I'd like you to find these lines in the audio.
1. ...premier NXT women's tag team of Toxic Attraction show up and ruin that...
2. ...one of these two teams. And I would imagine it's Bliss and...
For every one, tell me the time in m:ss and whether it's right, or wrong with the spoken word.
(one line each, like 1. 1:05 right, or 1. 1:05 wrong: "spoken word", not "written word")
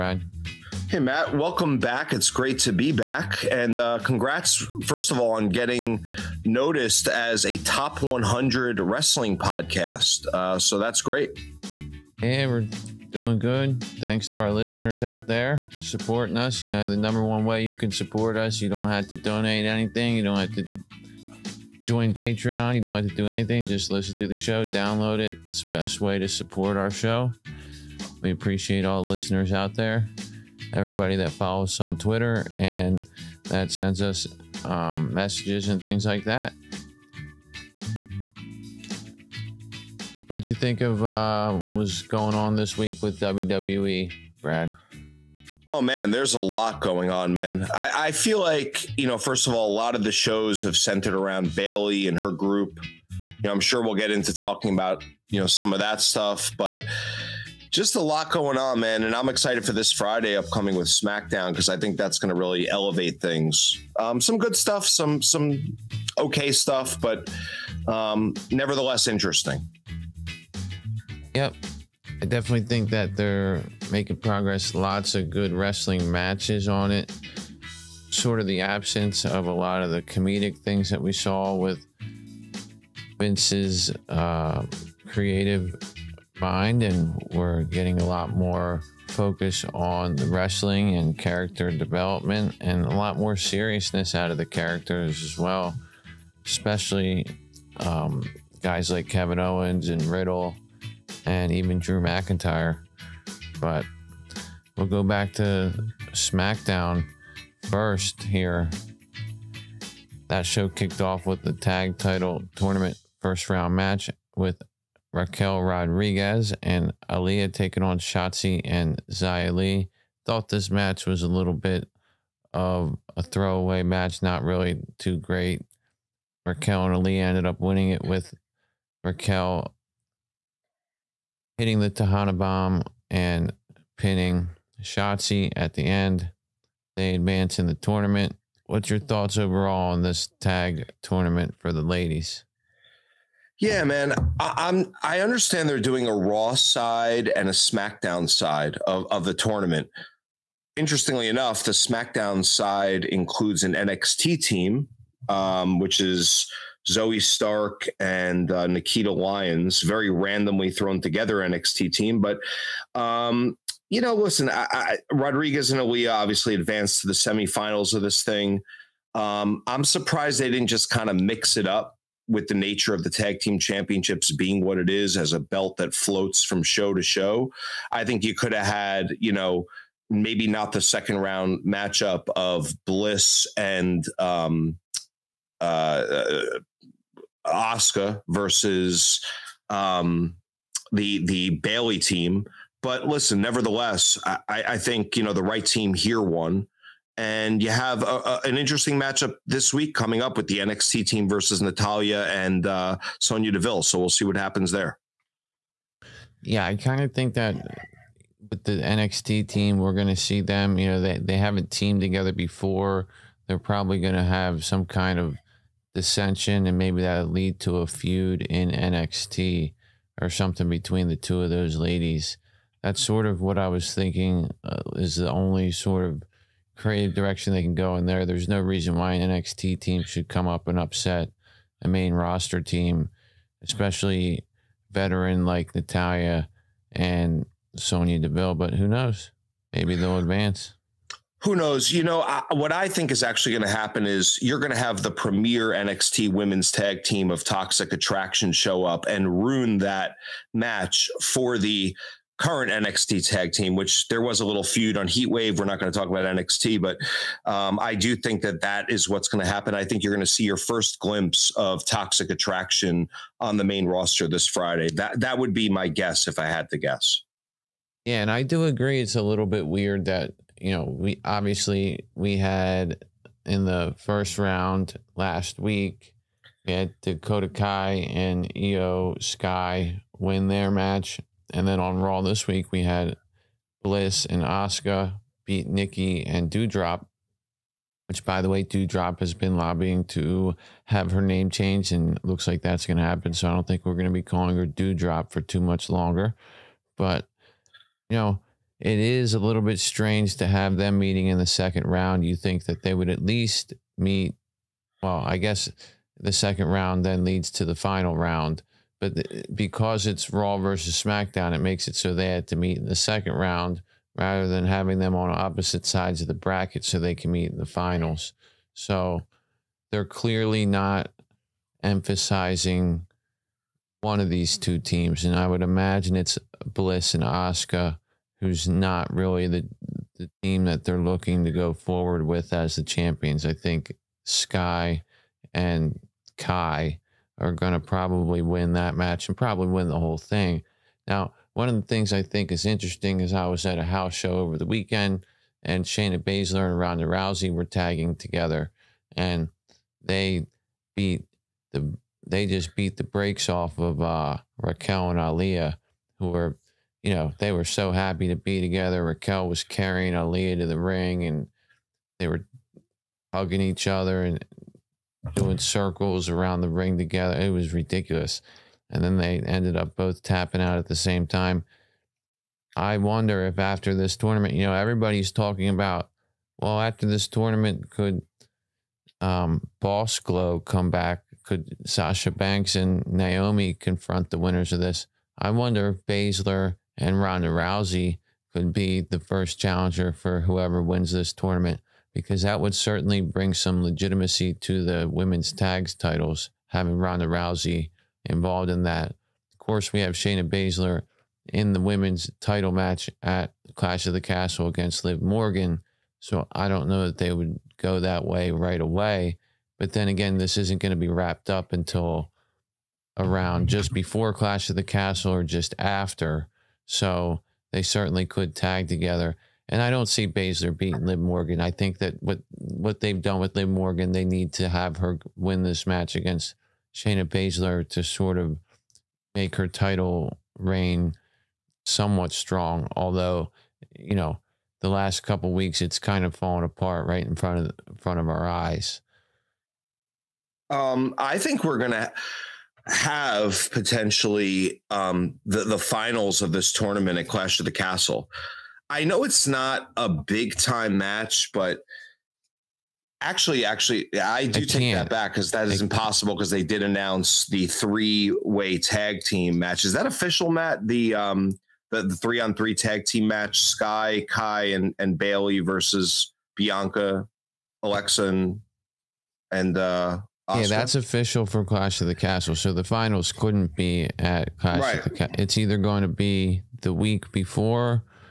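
1. 4:05 right
2. 5:24 right.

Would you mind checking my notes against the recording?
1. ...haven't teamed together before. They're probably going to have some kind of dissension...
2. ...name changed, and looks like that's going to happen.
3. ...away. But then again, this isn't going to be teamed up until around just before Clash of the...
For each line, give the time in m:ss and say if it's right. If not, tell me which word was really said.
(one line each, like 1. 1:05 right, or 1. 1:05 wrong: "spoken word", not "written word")
1. 3:31 right
2. 4:51 right
3. 6:48 wrong: "wrapped", not "teamed".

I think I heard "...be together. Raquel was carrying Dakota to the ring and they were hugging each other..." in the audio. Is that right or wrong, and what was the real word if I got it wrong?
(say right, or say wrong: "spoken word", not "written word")
wrong: "Aaliyah", not "Dakota".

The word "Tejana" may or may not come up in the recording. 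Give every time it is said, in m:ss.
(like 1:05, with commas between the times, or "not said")
2:11.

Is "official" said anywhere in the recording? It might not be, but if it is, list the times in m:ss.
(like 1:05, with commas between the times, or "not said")
7:40, 7:50.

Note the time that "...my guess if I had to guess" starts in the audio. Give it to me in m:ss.
4:25.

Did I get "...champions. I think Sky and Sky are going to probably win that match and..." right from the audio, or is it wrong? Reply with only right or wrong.
wrong.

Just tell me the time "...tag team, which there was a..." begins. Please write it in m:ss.
4:13.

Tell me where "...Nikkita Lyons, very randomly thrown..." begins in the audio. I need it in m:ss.
2:38.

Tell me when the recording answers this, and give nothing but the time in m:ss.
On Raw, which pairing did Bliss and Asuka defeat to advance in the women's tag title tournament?
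4:45.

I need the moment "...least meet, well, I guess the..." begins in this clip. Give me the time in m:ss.
5:03.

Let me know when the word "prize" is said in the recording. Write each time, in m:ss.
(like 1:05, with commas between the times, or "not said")
not said.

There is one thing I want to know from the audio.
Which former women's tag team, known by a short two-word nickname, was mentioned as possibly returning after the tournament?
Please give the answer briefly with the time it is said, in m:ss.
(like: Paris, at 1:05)
Boss Glow, at 6:19.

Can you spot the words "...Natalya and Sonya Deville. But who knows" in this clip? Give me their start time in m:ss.
3:55.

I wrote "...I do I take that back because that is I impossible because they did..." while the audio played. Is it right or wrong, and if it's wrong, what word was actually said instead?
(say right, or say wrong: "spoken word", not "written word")
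right.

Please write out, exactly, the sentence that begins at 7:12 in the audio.
Although, you know, the last couple weeks it's kind of fallen apart right in front of in front of our eyes.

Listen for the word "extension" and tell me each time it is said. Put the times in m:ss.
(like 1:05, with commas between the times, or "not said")
not said.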